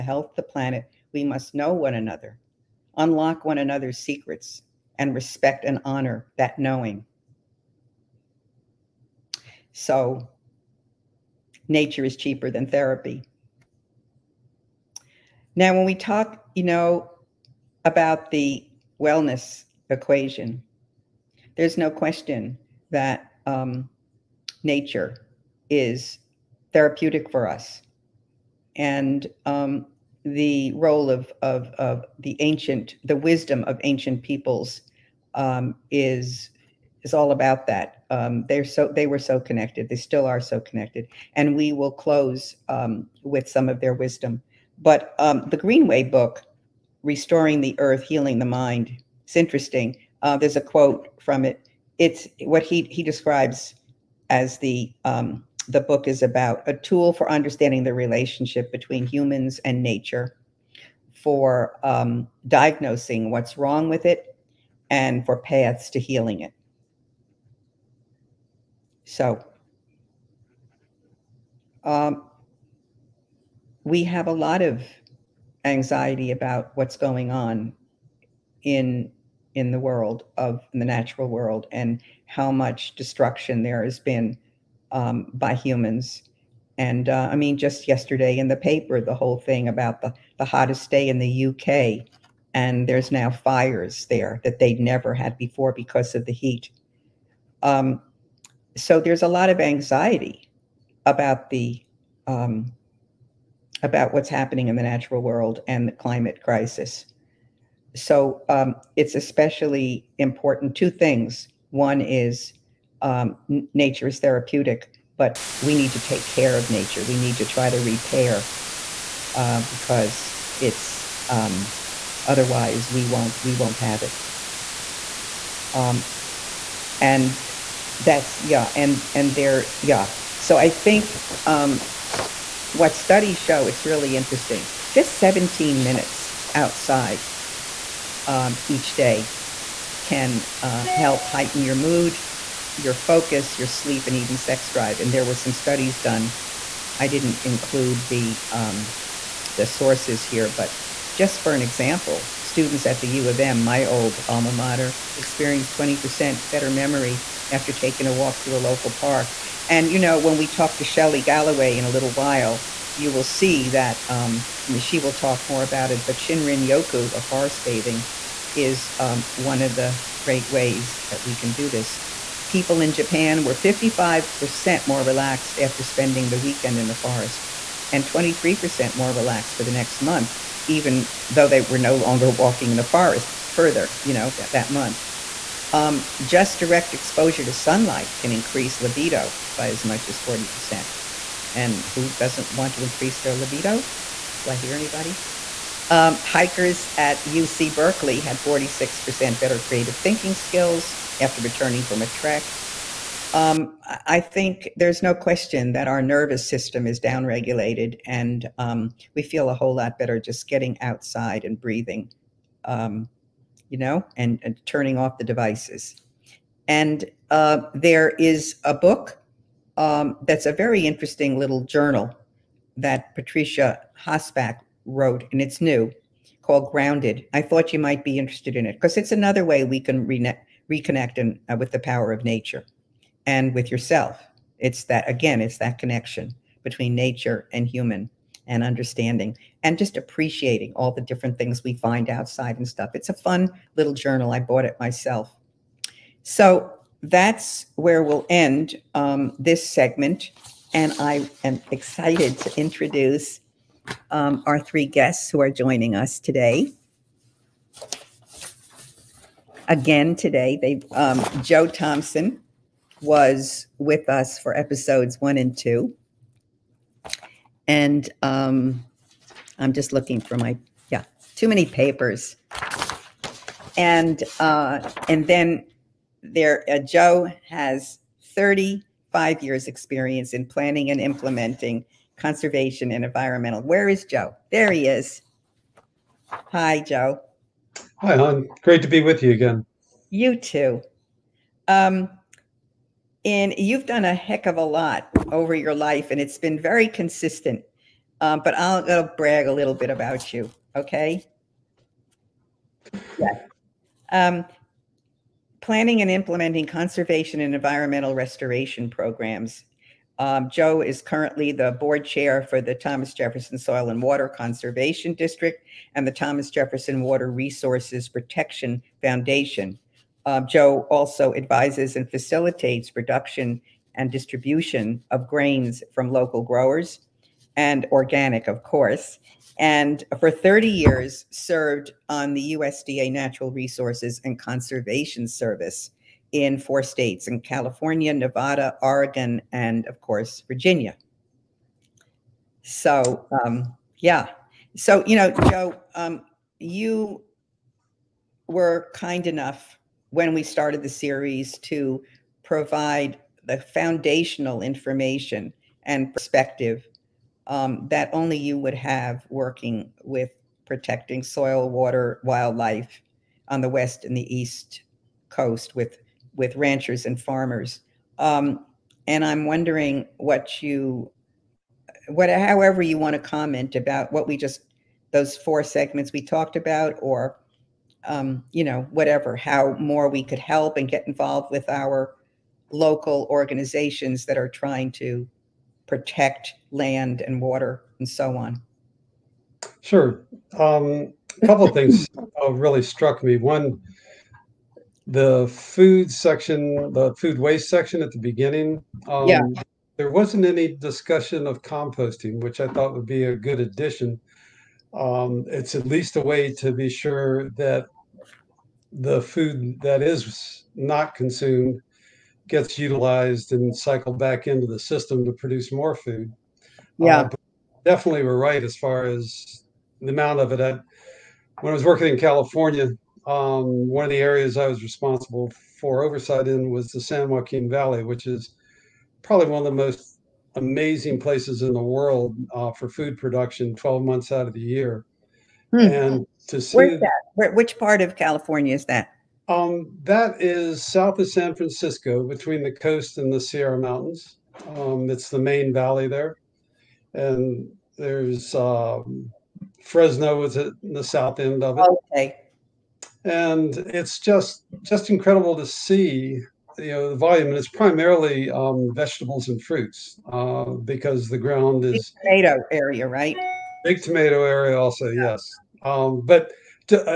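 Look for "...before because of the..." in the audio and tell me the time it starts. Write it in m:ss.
1:35.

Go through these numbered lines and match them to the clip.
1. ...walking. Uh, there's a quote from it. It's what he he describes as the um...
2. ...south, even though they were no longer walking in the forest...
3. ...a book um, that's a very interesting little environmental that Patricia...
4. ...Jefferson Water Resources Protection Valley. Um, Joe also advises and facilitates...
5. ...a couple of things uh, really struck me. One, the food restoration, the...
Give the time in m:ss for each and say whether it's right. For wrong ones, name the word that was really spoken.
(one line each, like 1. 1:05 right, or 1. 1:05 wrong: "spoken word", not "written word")
1. 0:49 wrong: "interesting", not "walking"
2. 2:59 wrong: "month", not "south"
3. 3:38 wrong: "journal", not "environmental"
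4. 5:16 wrong: "Foundation", not "Valley"
5. 6:31 wrong: "section", not "restoration".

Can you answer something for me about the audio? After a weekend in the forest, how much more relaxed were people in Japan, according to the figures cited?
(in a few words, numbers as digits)
55%.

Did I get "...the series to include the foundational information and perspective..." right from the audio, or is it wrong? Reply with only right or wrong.
wrong.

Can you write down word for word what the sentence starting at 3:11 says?
And who doesn't want to increase their libido?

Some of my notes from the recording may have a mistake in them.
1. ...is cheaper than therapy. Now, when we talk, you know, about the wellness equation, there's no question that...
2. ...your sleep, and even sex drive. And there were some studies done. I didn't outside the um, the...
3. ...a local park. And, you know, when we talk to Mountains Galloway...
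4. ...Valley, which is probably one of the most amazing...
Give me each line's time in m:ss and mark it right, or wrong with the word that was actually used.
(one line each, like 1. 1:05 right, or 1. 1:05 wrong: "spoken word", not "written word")
1. 0:12 right
2. 2:23 wrong: "include", not "outside"
3. 2:38 wrong: "Shelley", not "Mountains"
4. 7:07 right.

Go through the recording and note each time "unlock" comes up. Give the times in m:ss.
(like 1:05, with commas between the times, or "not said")
0:02.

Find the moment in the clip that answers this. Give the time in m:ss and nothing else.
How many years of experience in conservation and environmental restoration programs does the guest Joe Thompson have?
4:38.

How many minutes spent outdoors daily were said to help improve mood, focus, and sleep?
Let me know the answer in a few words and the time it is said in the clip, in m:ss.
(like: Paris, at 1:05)
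17, at 2:15.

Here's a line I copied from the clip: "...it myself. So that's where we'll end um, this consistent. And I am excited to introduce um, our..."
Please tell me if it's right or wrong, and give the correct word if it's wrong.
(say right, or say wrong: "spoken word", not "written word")
wrong: "segment", not "consistent".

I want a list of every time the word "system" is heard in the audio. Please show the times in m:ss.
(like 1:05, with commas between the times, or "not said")
3:26, 6:54.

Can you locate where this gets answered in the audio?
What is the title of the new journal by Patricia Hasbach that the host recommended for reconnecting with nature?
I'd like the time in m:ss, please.
3:46.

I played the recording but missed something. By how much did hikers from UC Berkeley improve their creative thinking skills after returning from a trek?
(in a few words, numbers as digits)
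46%.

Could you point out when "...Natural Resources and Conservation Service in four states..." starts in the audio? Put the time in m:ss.
5:33.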